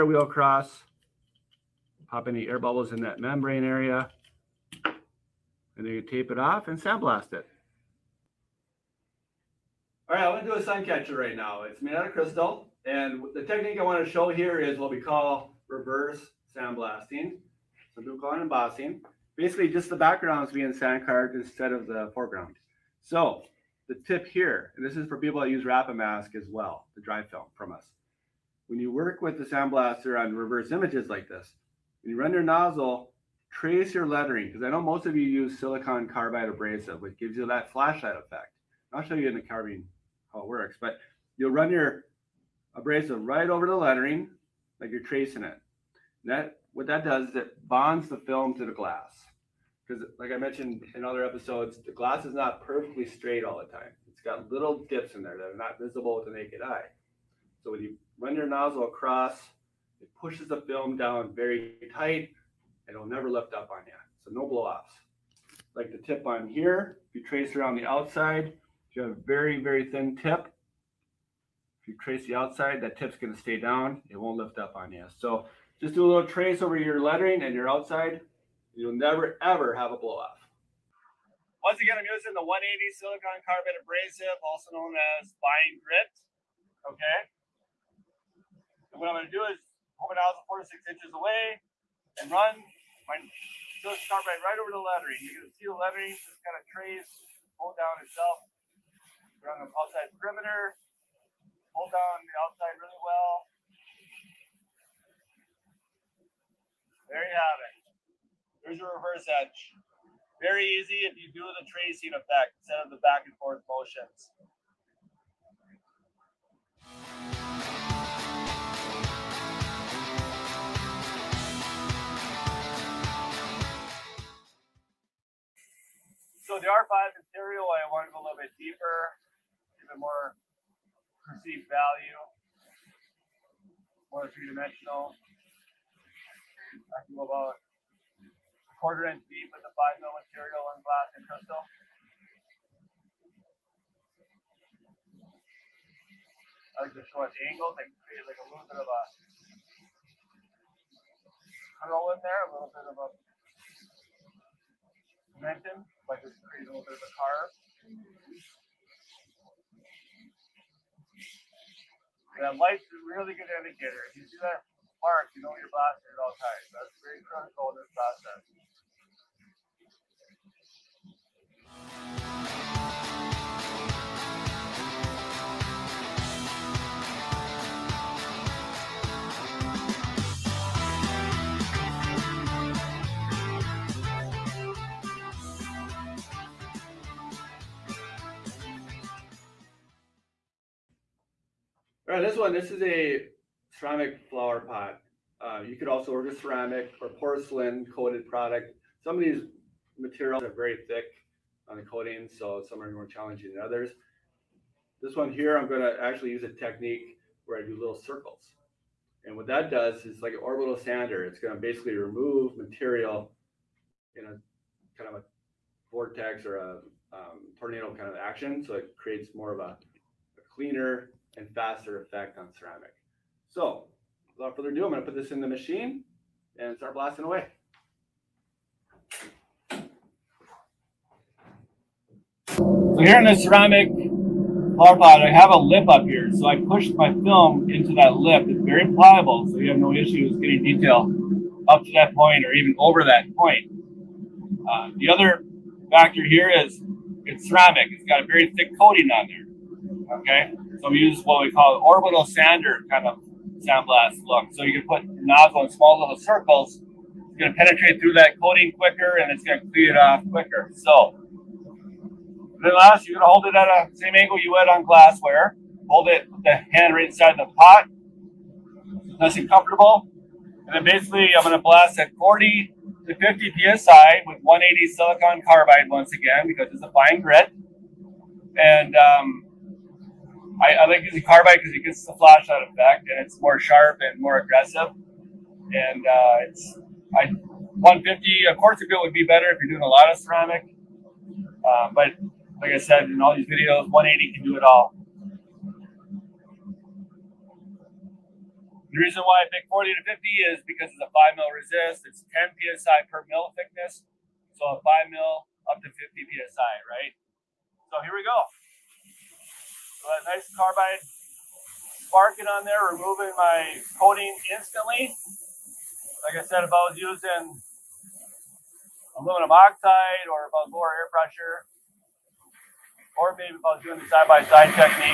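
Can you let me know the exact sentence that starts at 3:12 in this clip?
All right, this one, this is a ceramic flower pot.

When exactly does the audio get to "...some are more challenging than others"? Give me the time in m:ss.
3:22.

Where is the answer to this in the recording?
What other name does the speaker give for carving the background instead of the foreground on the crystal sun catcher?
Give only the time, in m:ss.
0:18.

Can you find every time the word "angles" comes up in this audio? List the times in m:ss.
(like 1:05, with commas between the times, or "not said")
2:27, 4:24.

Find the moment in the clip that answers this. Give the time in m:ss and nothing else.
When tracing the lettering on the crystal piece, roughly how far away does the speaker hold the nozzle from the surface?
1:30.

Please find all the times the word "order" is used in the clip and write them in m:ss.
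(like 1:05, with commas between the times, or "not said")
3:16.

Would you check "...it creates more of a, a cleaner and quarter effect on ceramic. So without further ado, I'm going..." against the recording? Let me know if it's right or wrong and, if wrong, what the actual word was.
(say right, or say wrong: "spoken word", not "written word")
wrong: "faster", not "quarter".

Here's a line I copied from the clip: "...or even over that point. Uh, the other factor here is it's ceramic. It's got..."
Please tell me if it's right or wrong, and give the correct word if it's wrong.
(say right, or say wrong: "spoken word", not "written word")
right.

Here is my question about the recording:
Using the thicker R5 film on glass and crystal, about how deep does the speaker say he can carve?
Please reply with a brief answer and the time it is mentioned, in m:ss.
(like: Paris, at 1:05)
A quarter inch, at 2:18.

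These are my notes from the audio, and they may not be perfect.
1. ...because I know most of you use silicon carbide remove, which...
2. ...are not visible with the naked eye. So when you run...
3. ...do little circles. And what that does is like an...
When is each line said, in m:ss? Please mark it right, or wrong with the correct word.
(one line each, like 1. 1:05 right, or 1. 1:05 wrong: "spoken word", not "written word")
1. 0:34 wrong: "abrasive", not "remove"
2. 0:55 right
3. 3:27 right.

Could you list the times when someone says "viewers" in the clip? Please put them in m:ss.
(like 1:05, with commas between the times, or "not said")
not said.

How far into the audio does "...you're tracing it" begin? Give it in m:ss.
0:44.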